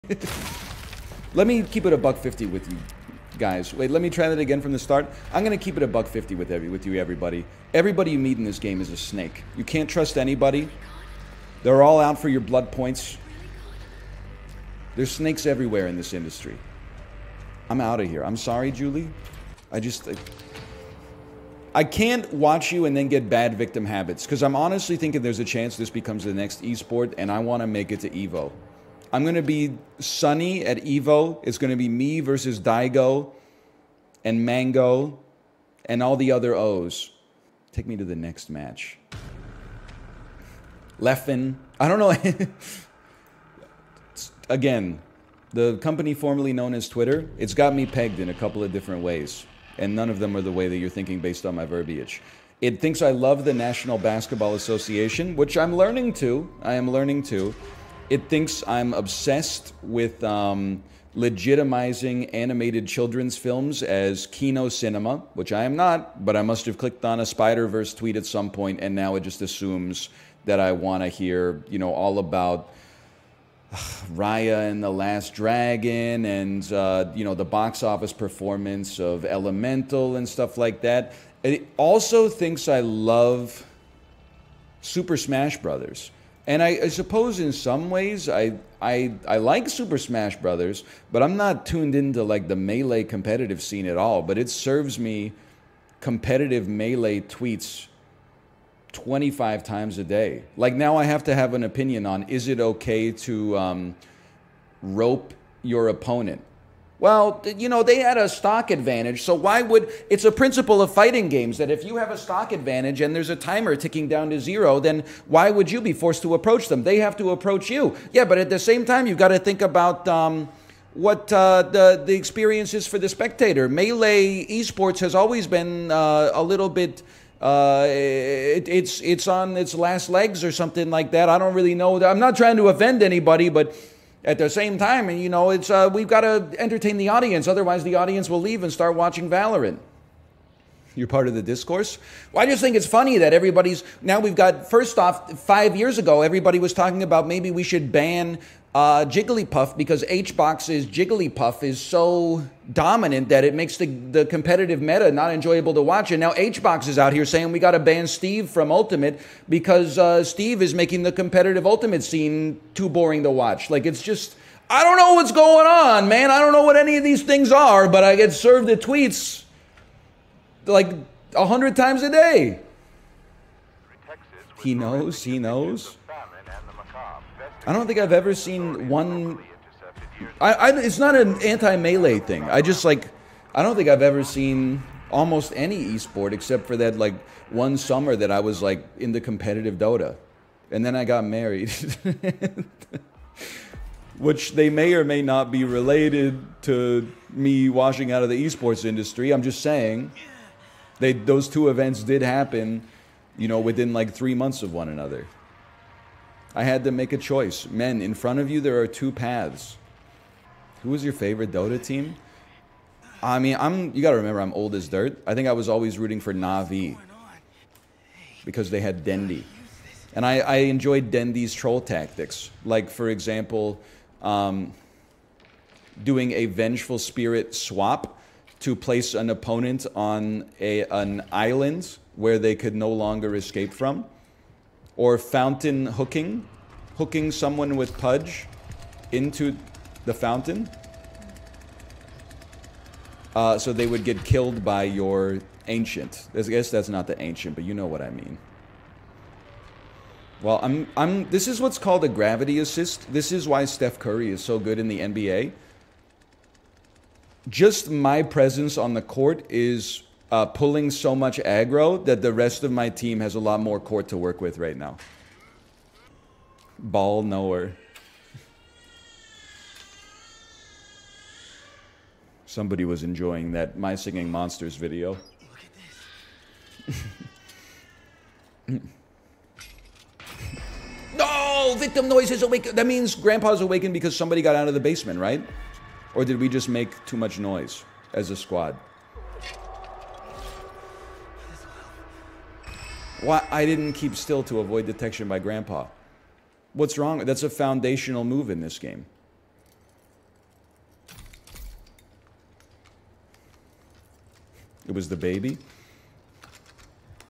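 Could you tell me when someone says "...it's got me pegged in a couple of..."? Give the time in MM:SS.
00:47.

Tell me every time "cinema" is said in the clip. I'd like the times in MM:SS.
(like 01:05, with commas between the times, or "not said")
01:04.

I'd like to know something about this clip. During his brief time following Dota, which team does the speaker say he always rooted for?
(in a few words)
Navi.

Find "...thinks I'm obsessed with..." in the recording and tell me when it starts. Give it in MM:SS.
00:58.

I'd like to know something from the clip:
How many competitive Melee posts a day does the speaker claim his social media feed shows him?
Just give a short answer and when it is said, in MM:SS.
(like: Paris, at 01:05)
25, at 01:38.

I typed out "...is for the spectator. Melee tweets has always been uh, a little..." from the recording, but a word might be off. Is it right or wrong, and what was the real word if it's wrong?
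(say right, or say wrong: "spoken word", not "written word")
wrong: "esports", not "tweets".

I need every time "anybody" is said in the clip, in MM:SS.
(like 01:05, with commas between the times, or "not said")
00:10, 02:13.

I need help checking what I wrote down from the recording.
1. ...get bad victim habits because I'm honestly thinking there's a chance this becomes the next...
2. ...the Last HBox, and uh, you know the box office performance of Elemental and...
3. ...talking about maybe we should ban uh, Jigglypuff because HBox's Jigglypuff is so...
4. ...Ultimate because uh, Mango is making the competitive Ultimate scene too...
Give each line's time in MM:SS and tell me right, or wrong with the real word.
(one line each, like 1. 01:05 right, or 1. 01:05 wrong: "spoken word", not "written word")
1. 00:23 right
2. 01:14 wrong: "Dragon", not "HBox"
3. 02:26 right
4. 02:38 wrong: "Steve", not "Mango".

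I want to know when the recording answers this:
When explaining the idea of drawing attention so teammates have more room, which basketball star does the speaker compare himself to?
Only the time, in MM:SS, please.
04:13.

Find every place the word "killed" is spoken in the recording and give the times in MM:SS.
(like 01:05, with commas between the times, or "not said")
04:04.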